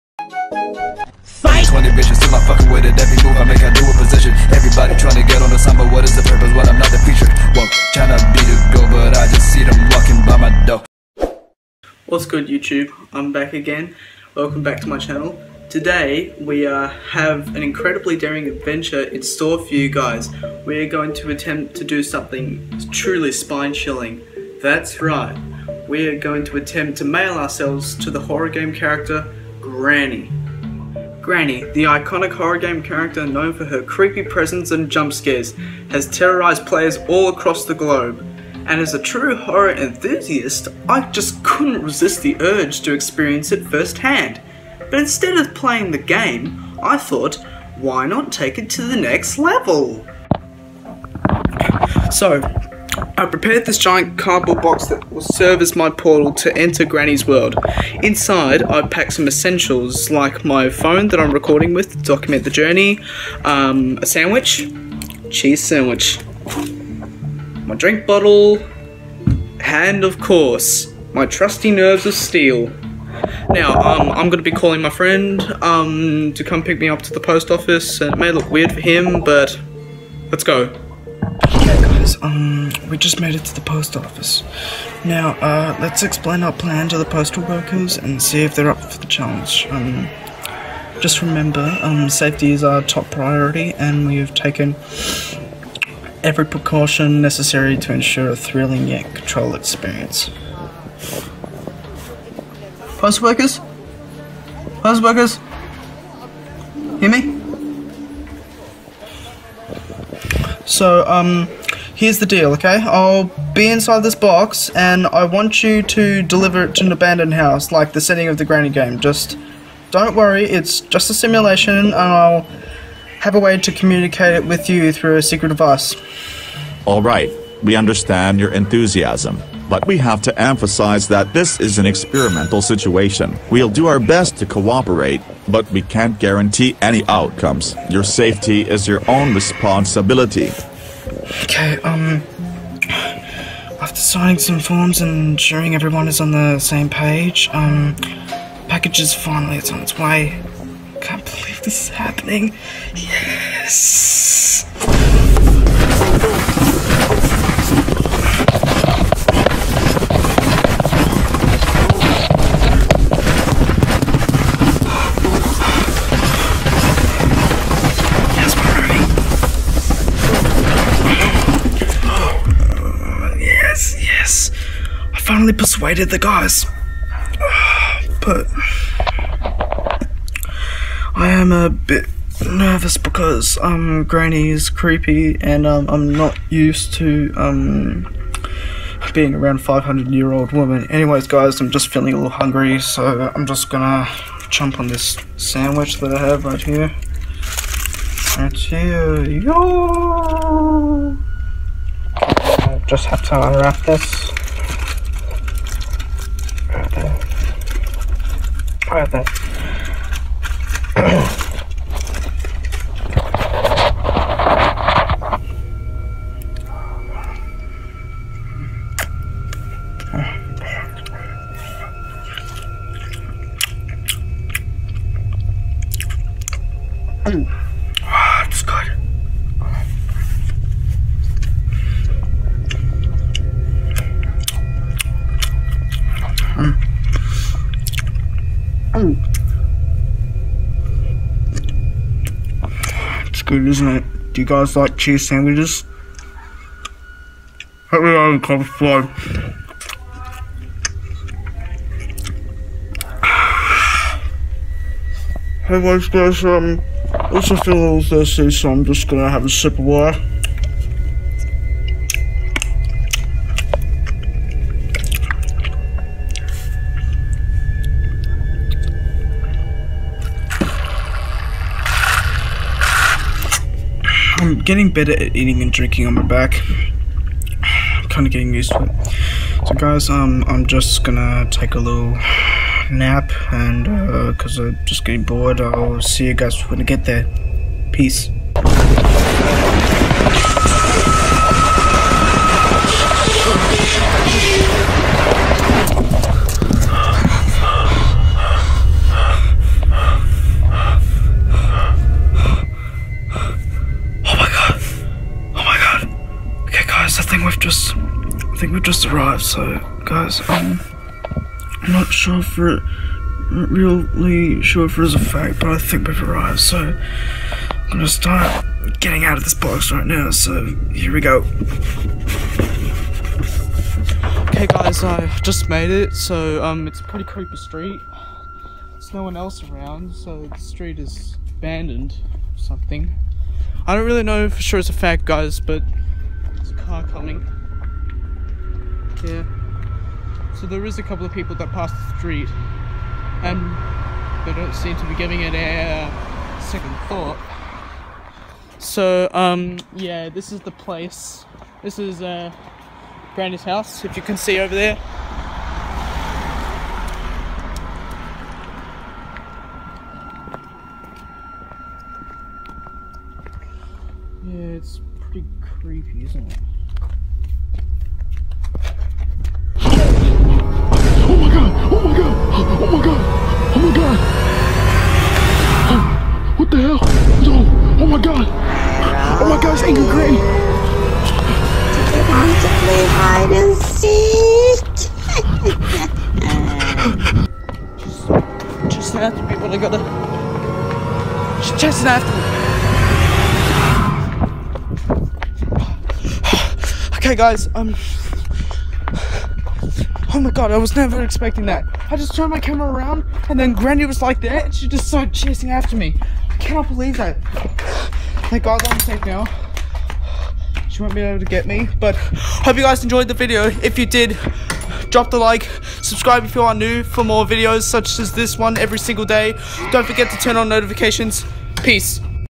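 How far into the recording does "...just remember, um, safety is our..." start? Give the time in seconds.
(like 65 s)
91 s.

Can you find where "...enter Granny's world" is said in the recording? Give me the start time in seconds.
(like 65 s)
56 s.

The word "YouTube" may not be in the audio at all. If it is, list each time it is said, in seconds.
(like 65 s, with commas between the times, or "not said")
12 s.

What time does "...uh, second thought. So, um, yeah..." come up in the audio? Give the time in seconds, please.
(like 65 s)
346 s.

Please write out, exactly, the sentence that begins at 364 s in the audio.
Yeah, it's pretty creepy, isn't it?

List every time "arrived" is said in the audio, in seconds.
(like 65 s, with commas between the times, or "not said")
309 s, 316 s.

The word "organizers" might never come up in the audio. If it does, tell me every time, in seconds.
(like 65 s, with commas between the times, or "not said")
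not said.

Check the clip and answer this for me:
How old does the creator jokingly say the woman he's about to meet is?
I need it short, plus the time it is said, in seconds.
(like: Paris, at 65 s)
500, at 189 s.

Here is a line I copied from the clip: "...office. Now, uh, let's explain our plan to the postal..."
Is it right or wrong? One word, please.
right.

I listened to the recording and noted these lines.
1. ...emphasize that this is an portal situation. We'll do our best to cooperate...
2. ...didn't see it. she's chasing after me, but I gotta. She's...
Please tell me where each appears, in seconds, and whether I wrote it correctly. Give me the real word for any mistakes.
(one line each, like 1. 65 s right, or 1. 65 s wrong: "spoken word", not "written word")
1. 130 s wrong: "experimental", not "portal"
2. 383 s right.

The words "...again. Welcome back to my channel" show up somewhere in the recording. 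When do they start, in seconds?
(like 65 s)
13 s.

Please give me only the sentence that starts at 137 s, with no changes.
Your safety is your own responsibility.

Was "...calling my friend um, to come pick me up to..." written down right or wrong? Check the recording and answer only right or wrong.
right.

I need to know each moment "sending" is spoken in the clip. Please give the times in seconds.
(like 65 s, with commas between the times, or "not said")
not said.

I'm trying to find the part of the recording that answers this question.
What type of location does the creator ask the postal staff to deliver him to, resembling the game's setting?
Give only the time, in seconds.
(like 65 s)
116 s.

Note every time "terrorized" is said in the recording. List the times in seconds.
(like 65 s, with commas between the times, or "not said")
36 s.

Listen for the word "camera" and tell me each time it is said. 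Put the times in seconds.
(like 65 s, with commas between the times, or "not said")
402 s.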